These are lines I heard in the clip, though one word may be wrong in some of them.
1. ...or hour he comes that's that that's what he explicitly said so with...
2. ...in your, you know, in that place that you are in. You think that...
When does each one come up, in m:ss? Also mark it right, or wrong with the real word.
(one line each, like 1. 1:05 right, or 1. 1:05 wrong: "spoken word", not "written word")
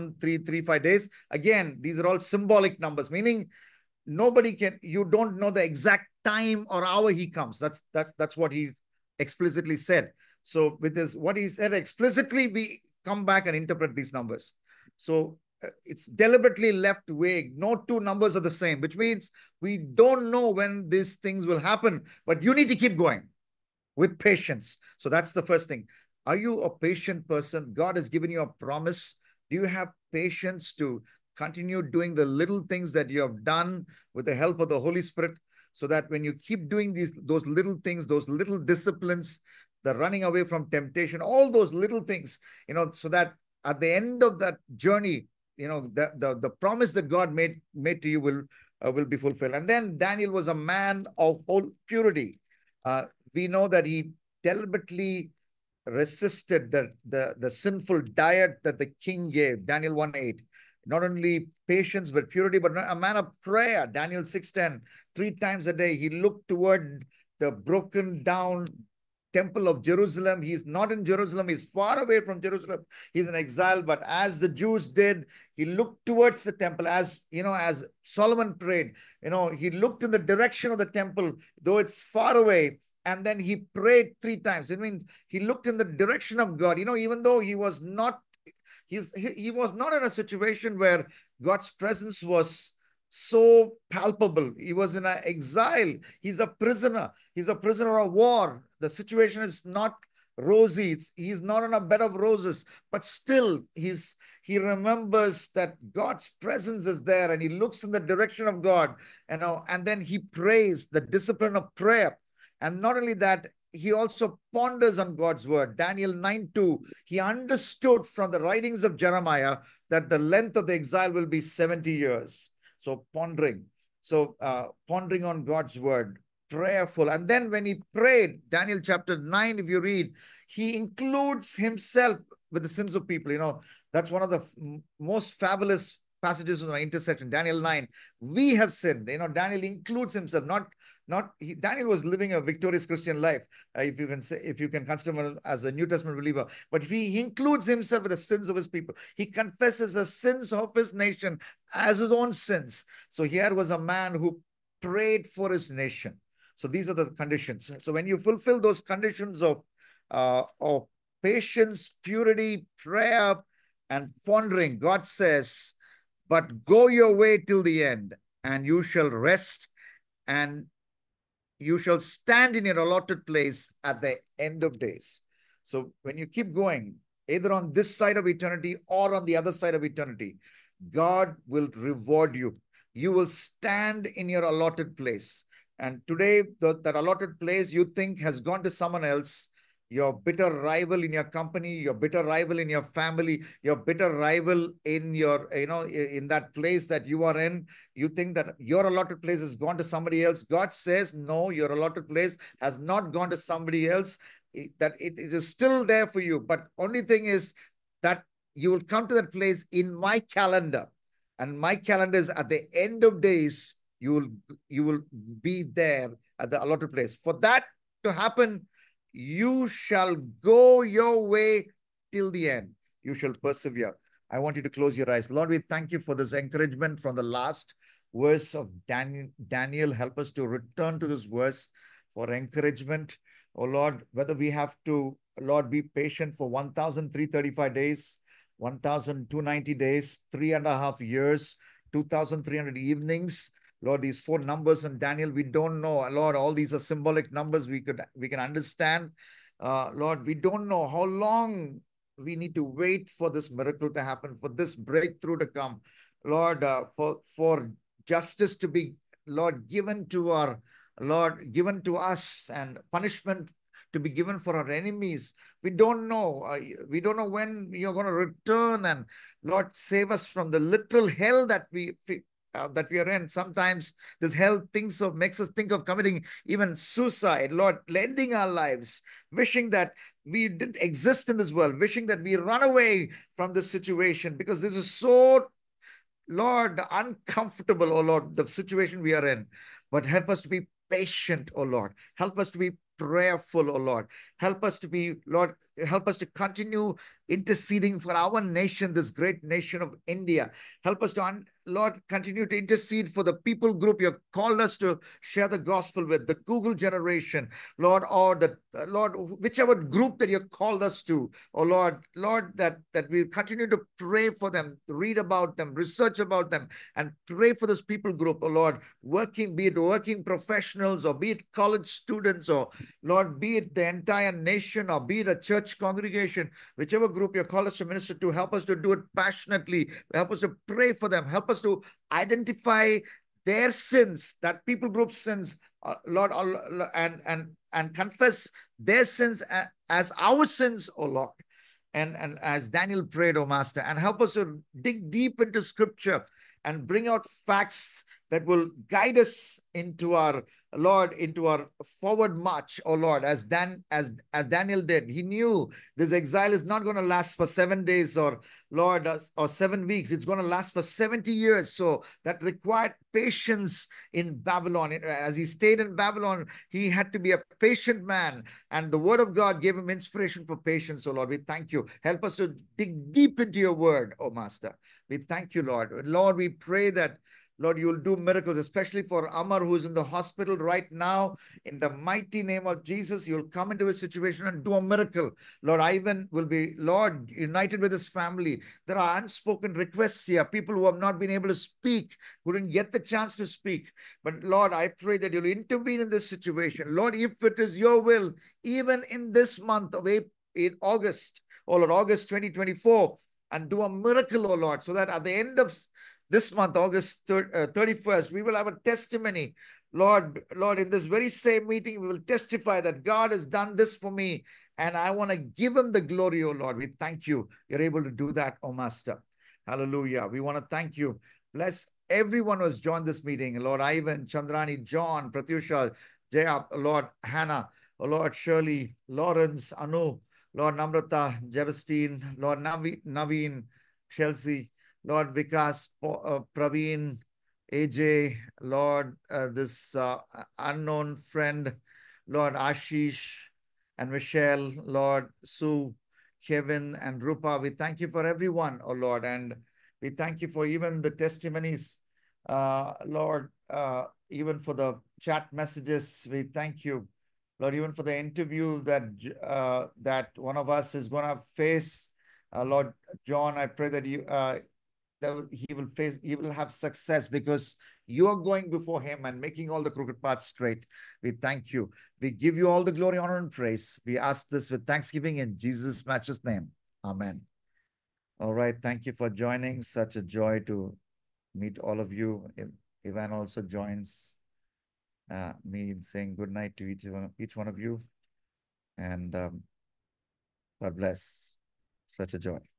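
1. 0:06 right
2. 3:14 right.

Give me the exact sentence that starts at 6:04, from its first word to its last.
As he stayed in Babylon, he had to be a patient man.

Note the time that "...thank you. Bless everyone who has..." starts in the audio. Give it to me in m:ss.
7:00.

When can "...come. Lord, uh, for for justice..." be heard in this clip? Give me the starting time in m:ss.
4:15.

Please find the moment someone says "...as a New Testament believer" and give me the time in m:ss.
2:25.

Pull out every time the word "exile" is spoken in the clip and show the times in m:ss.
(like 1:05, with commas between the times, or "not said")
1:13, 1:35, 2:00, 5:56.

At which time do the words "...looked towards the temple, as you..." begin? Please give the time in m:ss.
1:15.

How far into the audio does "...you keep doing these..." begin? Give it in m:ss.
0:36.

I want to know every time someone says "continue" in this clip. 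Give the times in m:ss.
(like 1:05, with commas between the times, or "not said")
0:31, 4:56, 5:02, 5:13.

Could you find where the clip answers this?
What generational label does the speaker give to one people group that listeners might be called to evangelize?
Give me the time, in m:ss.
5:06.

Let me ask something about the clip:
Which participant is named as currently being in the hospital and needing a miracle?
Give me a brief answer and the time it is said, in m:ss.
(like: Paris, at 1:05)
Amar, at 6:19.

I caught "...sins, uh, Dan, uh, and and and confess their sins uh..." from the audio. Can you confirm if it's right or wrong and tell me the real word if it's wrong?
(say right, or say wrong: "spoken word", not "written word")
wrong: "Lord", not "Dan".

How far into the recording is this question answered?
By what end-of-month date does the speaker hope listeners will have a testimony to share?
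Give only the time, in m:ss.
6:46.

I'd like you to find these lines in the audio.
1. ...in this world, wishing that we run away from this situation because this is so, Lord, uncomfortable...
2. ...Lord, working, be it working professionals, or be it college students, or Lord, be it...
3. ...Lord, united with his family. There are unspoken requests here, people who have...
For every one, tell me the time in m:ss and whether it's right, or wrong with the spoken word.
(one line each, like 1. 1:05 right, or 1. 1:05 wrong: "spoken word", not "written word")
1. 4:41 right
2. 5:18 right
3. 6:26 right.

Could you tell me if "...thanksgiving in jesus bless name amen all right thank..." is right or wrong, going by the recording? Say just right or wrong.
wrong.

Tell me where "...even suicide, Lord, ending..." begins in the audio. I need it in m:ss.
4:36.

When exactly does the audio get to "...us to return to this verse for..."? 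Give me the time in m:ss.
3:50.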